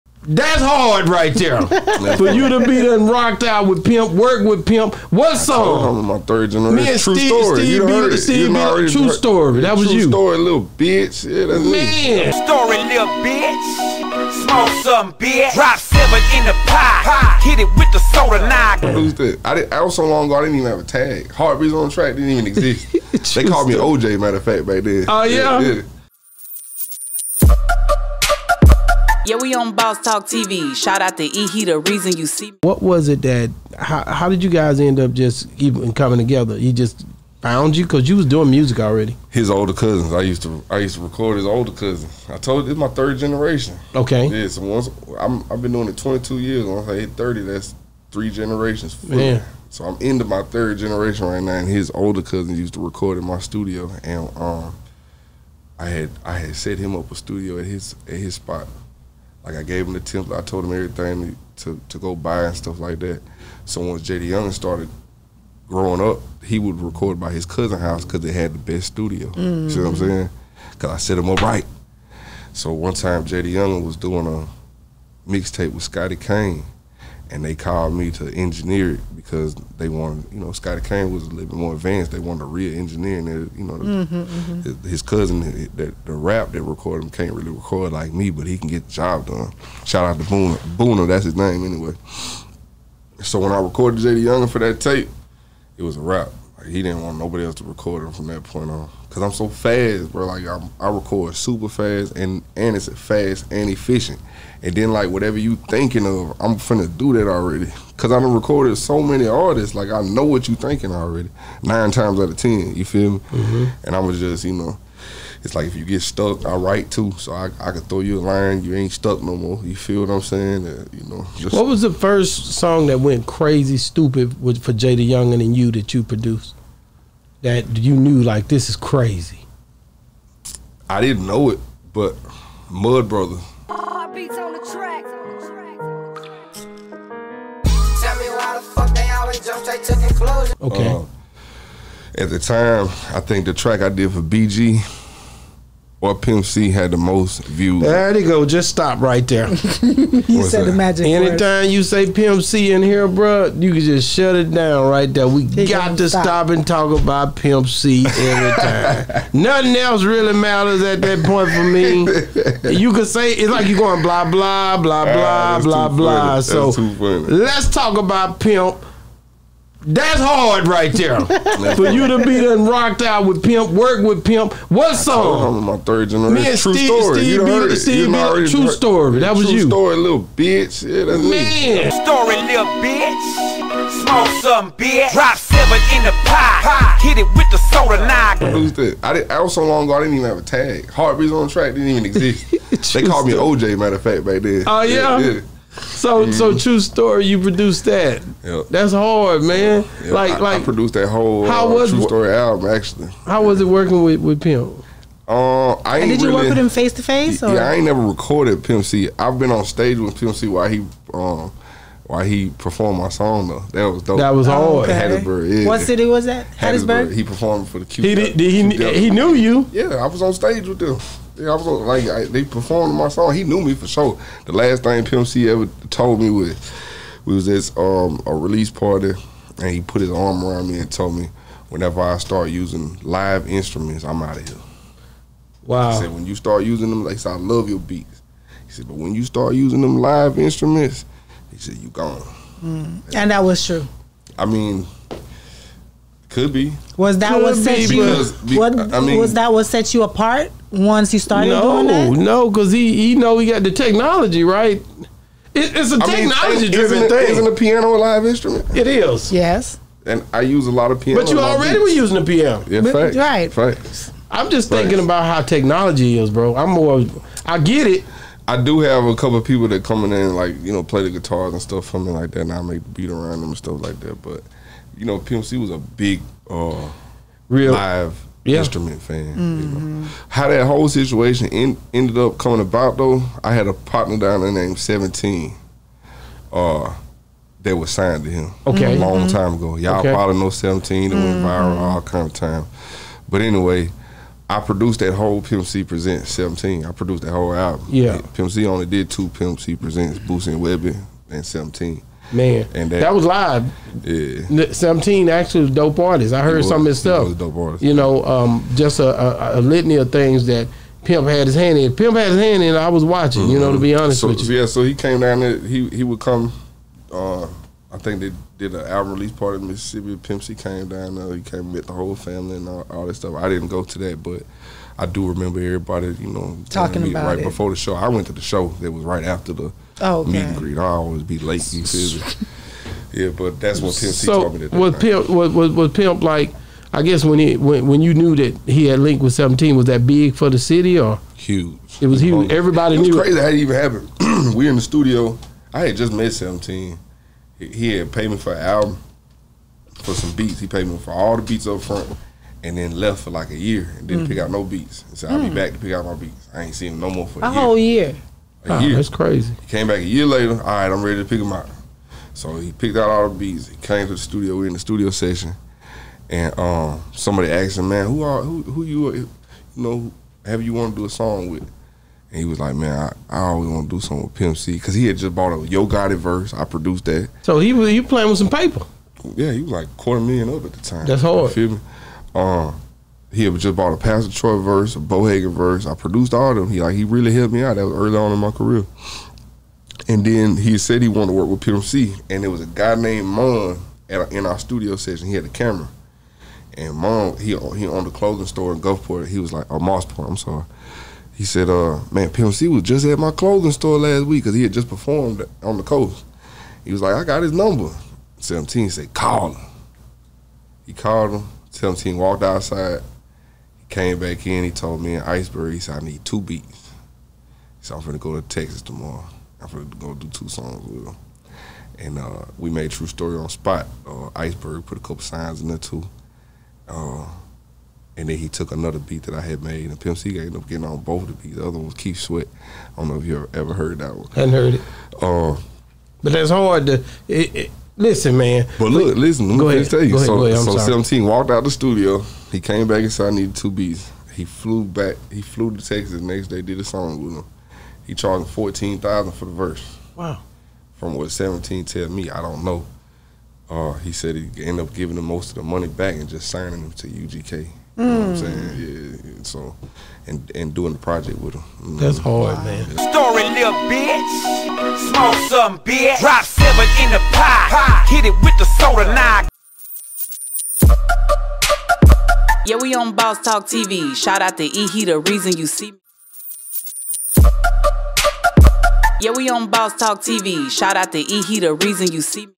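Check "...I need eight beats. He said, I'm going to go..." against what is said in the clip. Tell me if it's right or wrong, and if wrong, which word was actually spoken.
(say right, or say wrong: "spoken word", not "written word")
wrong: "two", not "eight".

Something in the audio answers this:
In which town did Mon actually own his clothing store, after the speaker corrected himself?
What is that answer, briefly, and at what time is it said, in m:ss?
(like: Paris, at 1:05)
Moss Point, at 6:39.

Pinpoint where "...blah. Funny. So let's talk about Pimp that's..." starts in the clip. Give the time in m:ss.
2:45.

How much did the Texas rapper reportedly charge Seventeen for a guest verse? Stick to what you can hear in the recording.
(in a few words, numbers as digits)
$14,000.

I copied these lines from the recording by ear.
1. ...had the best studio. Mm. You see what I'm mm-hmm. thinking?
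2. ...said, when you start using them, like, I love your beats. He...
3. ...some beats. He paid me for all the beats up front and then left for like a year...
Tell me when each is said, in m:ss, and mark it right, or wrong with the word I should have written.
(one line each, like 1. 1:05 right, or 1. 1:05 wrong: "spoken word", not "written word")
1. 1:08 wrong: "saying", not "thinking"
2. 3:55 right
3. 5:50 right.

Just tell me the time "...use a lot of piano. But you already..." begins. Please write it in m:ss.
4:20.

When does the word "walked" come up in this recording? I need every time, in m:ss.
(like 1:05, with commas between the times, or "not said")
6:52, 7:21.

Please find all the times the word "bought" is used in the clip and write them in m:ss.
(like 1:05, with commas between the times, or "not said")
6:15, 6:23.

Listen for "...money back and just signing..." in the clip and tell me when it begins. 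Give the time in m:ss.
7:35.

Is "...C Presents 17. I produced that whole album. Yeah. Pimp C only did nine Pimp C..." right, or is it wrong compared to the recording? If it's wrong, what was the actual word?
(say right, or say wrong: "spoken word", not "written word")
wrong: "two", not "nine".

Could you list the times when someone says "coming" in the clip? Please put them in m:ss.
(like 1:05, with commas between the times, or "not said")
0:35, 4:29, 4:42.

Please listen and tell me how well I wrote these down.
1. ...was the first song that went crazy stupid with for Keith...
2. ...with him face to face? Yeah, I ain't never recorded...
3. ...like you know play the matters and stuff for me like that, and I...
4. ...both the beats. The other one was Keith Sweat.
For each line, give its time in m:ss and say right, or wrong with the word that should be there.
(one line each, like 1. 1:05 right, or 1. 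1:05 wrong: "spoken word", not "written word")
1. 2:01 wrong: "JayDaYoungan", not "Keith"
2. 3:26 right
3. 4:30 wrong: "guitars", not "matters"
4. 7:10 right.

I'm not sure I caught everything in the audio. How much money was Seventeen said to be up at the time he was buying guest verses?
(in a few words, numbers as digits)
quarter million.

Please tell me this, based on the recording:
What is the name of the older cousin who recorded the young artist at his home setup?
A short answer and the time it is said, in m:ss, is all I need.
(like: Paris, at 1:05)
Boona, at 1:30.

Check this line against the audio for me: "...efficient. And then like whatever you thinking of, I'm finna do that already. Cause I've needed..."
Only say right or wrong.
wrong.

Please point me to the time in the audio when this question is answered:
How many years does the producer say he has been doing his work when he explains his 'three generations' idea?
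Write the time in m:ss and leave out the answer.
0:45.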